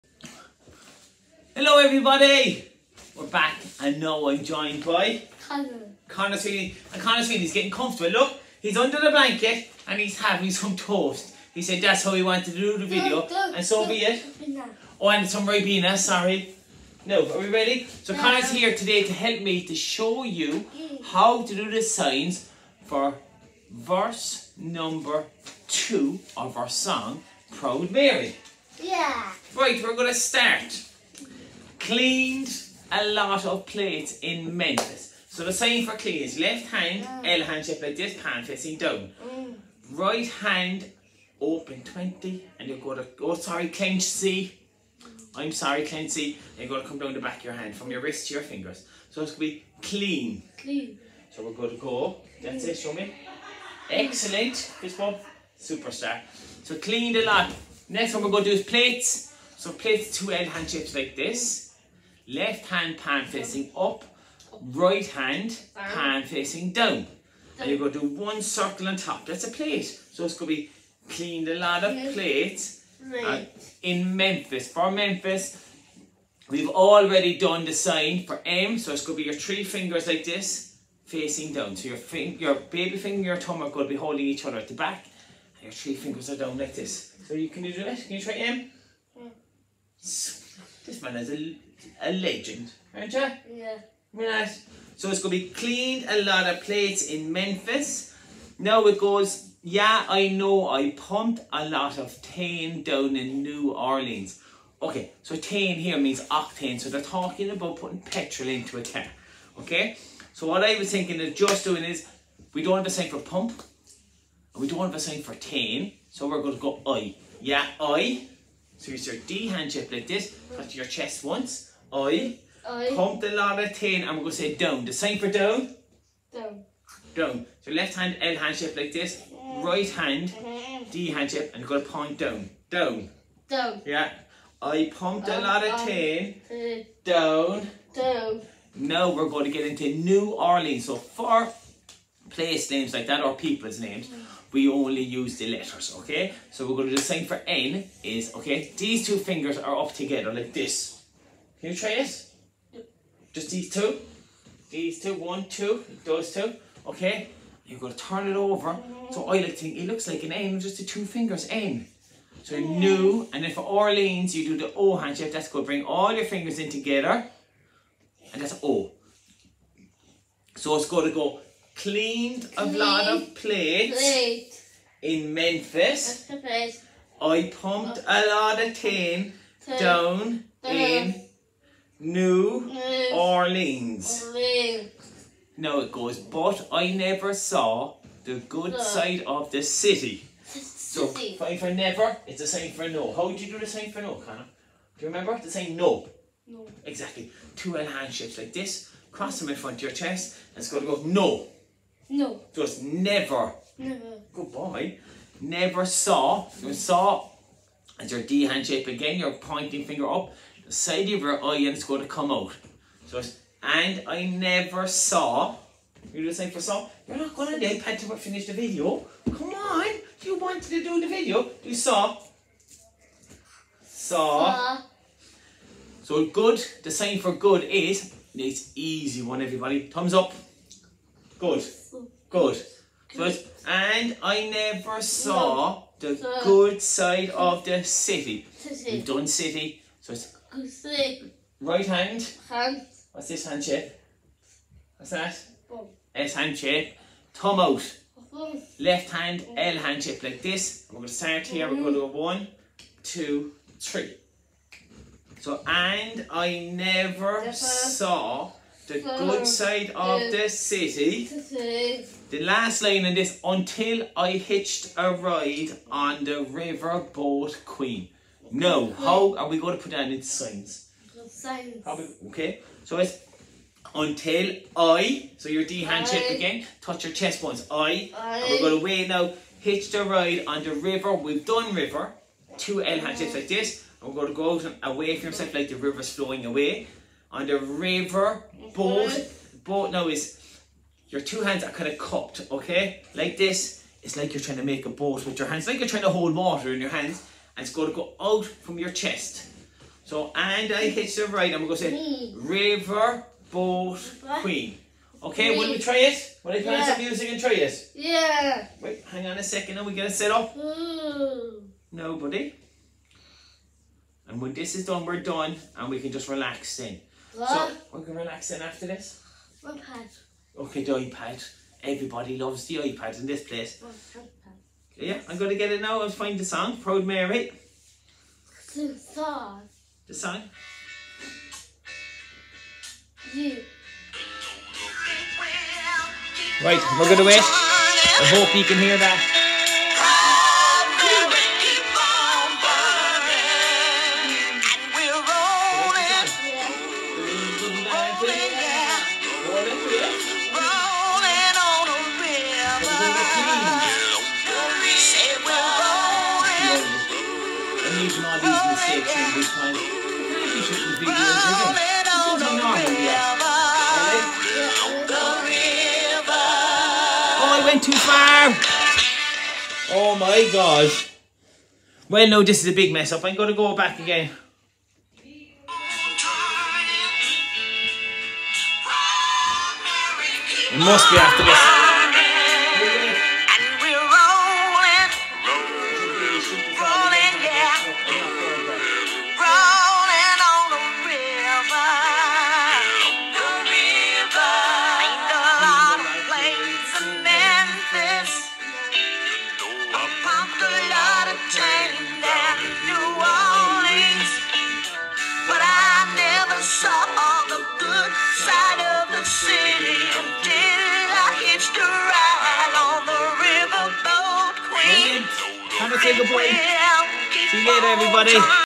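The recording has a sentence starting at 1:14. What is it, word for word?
For Memphis, we've already done the sign for M.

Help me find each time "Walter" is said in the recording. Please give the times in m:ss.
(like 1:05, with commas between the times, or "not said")
not said.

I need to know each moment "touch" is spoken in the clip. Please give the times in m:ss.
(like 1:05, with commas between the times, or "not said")
2:00, 4:36.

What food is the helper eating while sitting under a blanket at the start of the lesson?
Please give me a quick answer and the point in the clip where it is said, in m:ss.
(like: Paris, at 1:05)
Toast, at 0:10.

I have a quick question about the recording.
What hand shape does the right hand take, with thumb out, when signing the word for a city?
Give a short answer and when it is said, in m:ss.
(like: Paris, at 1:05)
S hand shape, at 4:06.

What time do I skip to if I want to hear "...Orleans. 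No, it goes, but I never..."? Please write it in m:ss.
3:03.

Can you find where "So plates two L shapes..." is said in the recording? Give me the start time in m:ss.
0:59.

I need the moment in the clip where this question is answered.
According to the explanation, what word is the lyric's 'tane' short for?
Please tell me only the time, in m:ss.
1:46.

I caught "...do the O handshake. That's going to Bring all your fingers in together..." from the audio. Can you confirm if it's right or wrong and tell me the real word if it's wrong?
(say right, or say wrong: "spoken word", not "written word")
right.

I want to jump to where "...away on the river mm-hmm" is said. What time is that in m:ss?
4:46.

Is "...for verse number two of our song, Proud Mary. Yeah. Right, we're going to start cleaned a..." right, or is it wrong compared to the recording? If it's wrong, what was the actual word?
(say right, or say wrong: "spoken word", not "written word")
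right.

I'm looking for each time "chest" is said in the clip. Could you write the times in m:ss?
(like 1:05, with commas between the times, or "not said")
2:00, 3:19, 4:37, 4:58.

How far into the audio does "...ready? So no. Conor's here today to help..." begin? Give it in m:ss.
0:17.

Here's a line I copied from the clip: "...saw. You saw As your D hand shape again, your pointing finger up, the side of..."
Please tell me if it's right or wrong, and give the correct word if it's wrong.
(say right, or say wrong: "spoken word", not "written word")
right.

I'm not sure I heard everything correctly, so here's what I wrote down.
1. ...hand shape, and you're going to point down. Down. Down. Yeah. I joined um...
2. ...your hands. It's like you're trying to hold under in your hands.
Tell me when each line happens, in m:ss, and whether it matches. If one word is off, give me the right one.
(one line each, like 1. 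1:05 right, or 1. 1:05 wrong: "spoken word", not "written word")
1. 2:11 wrong: "pumped", not "joined"
2. 4:55 wrong: "water", not "under".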